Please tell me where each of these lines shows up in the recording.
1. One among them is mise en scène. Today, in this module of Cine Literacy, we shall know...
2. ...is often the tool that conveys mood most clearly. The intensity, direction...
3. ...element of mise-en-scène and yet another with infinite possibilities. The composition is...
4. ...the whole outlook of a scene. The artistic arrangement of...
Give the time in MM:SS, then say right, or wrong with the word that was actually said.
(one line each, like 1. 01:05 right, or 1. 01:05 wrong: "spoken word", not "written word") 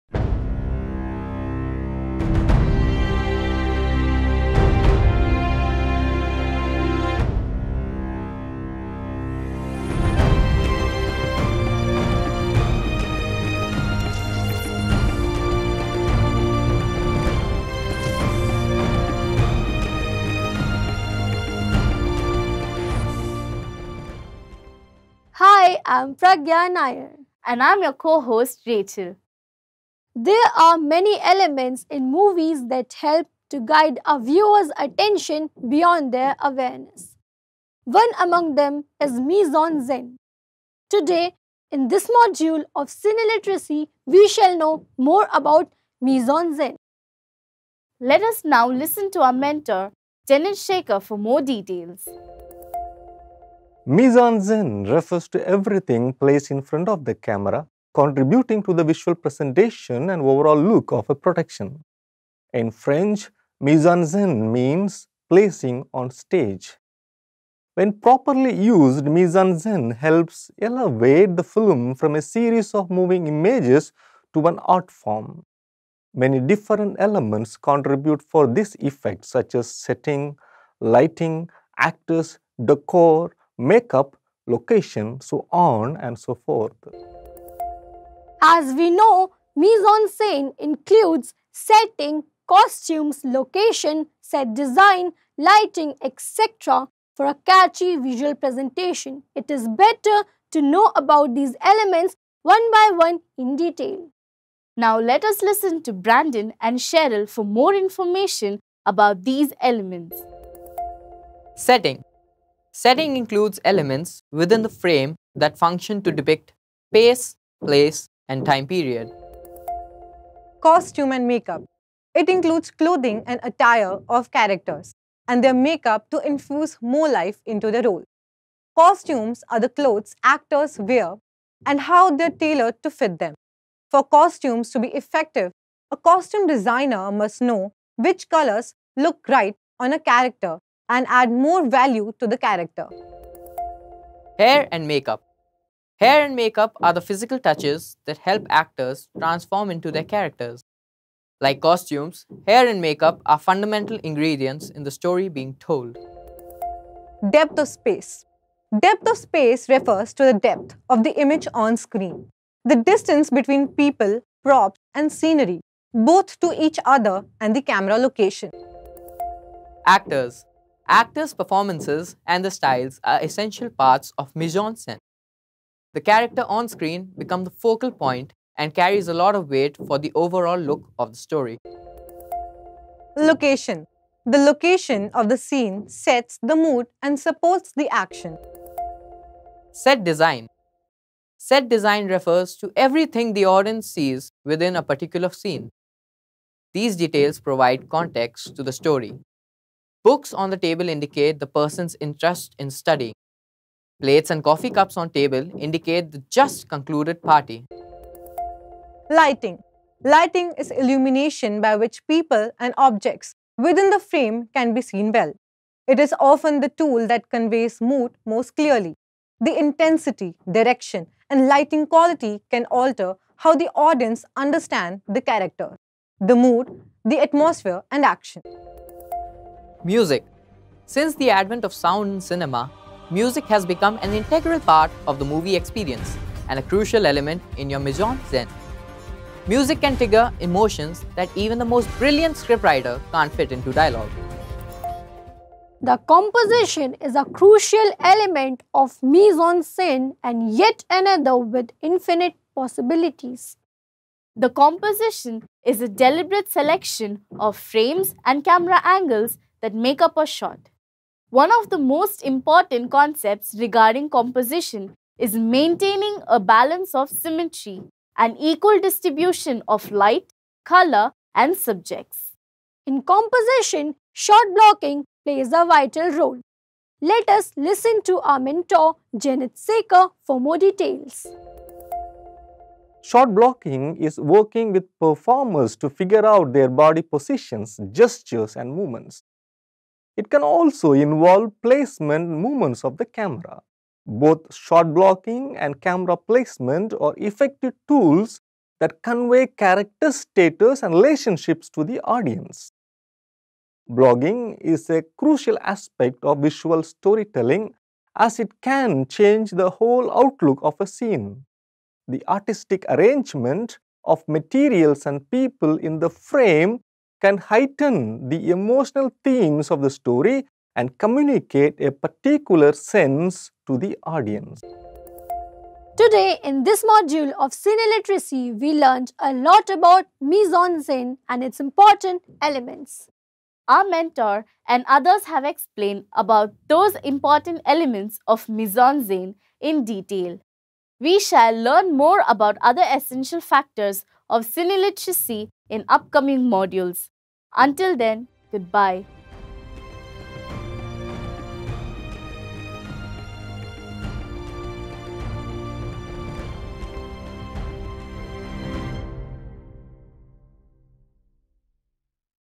1. 00:37 right
2. 03:35 right
3. 04:08 right
4. 05:09 right.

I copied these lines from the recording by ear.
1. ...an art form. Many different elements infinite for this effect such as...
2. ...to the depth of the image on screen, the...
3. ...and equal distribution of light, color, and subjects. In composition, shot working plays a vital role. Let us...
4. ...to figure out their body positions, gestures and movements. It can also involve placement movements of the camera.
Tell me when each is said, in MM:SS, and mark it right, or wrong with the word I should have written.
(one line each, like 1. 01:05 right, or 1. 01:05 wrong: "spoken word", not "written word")
1. 01:14 wrong: "contribute", not "infinite"
2. 02:40 right
3. 04:28 wrong: "blocking", not "working"
4. 04:45 right.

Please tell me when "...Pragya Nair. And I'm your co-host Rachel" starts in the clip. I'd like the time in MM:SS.
00:26.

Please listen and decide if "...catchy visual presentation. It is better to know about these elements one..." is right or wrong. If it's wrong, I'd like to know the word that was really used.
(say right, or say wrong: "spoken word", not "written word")
right.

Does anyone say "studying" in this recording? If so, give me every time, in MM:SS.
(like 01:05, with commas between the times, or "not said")
03:22.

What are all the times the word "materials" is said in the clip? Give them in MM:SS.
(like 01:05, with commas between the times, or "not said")
05:14.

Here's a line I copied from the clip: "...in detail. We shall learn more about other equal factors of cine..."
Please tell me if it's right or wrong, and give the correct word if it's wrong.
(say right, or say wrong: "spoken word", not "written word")
wrong: "essential", not "equal".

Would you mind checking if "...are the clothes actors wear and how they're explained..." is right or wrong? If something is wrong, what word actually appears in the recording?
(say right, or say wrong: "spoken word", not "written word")
wrong: "tailored", not "explained".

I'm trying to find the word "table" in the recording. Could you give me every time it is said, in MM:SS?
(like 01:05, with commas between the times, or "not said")
03:20, 03:25.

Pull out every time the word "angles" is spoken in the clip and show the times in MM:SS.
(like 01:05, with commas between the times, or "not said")
04:18.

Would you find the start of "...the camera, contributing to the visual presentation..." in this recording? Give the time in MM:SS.
00:57.